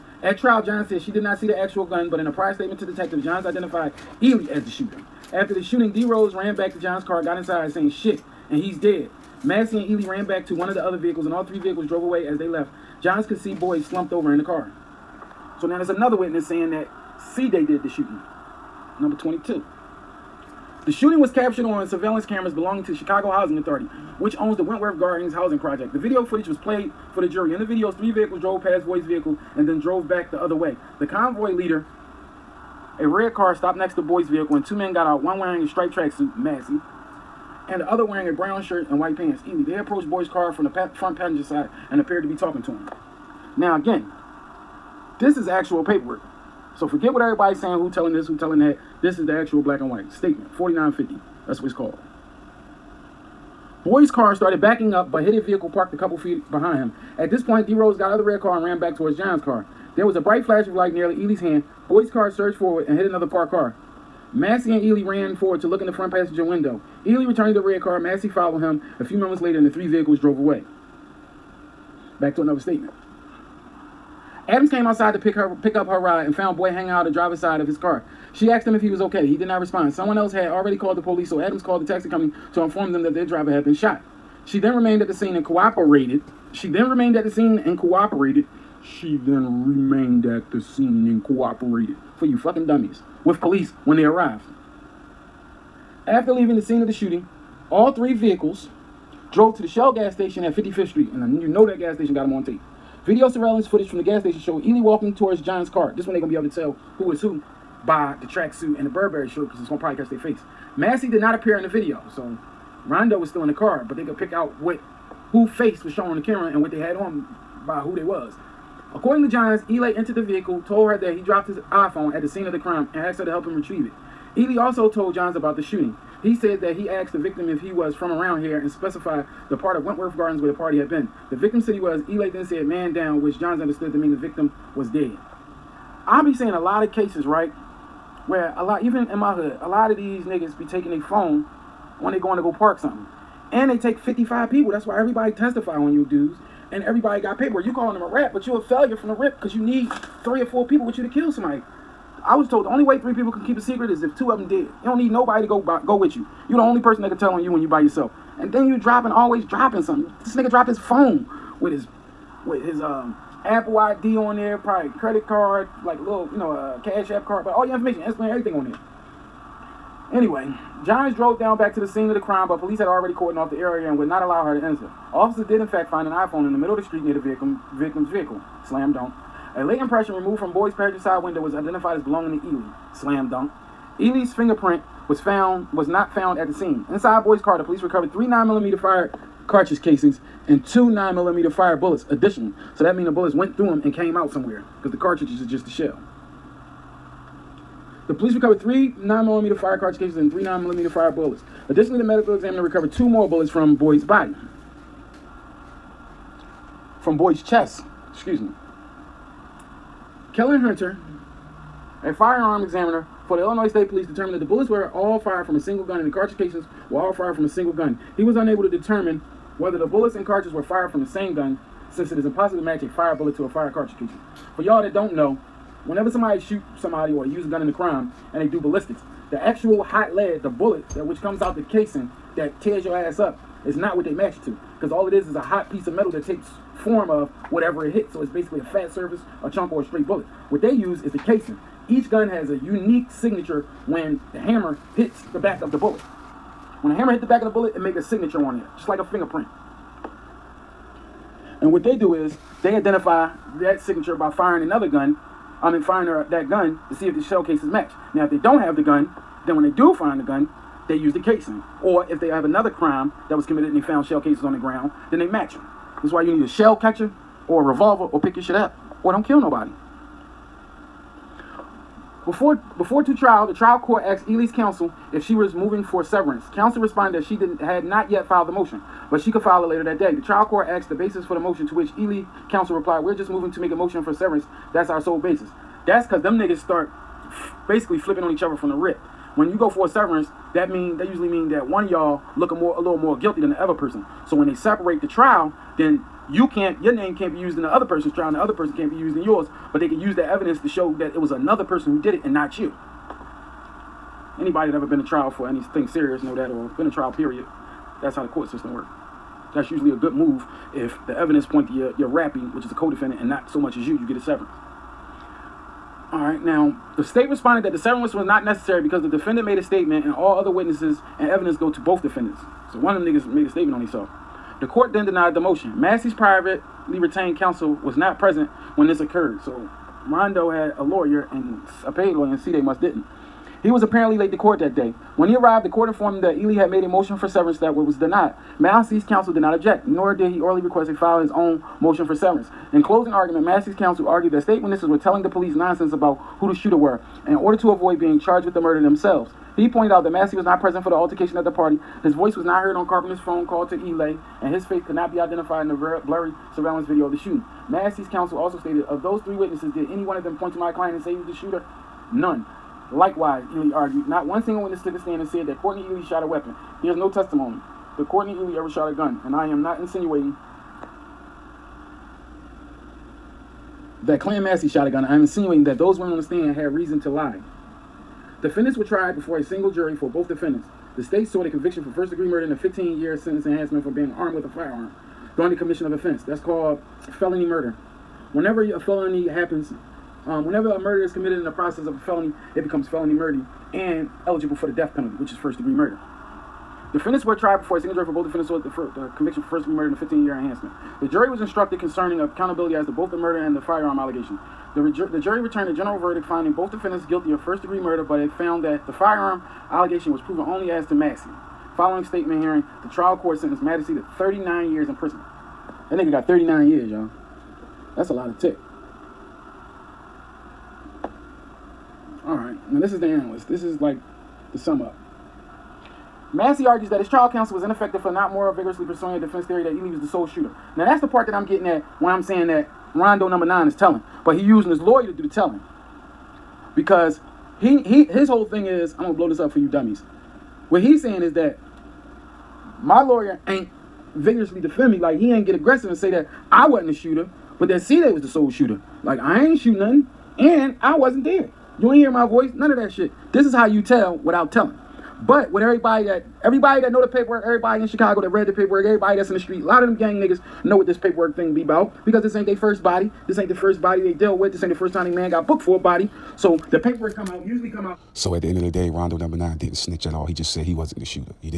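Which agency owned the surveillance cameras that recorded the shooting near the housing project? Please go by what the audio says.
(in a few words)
Chicago Housing Authority.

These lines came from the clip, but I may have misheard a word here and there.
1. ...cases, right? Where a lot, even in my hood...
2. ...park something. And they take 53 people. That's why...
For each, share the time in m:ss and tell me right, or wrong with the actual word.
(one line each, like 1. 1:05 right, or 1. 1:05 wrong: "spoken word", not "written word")
1. 2:16 right
2. 2:22 wrong: "55", not "53".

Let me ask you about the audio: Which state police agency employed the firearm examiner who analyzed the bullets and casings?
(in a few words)
Illinois State Police.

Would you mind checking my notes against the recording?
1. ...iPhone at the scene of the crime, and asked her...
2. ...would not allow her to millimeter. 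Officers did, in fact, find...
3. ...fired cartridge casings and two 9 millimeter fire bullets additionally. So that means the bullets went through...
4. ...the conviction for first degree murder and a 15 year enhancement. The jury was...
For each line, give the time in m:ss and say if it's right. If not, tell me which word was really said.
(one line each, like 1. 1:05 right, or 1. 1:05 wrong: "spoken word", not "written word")
1. 2:01 right
2. 2:53 wrong: "enter", not "millimeter"
3. 3:08 right
4. 6:38 right.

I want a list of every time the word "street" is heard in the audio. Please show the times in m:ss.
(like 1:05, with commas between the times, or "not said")
1:40, 2:56, 7:39.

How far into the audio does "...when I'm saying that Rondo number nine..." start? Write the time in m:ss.
7:12.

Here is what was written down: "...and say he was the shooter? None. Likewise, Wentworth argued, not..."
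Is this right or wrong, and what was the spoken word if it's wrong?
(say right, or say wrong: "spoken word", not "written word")
wrong: "Ely", not "Wentworth".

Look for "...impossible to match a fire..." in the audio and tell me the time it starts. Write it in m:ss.
3:42.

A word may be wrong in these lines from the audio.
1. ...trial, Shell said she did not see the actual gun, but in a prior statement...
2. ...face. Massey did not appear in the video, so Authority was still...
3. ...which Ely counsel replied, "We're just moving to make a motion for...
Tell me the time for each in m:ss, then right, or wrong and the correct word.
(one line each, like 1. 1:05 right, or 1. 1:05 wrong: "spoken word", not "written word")
1. 0:00 wrong: "John", not "Shell"
2. 1:50 wrong: "Rondo", not "Authority"
3. 4:41 right.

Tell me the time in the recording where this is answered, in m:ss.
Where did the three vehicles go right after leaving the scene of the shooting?
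1:39.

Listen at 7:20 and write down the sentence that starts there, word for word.
What he's saying is that my lawyer ain't vigorously defend me.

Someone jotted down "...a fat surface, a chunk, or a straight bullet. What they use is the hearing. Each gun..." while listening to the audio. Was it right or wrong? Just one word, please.
wrong.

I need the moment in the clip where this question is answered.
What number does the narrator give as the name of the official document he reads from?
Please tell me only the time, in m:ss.
0:50.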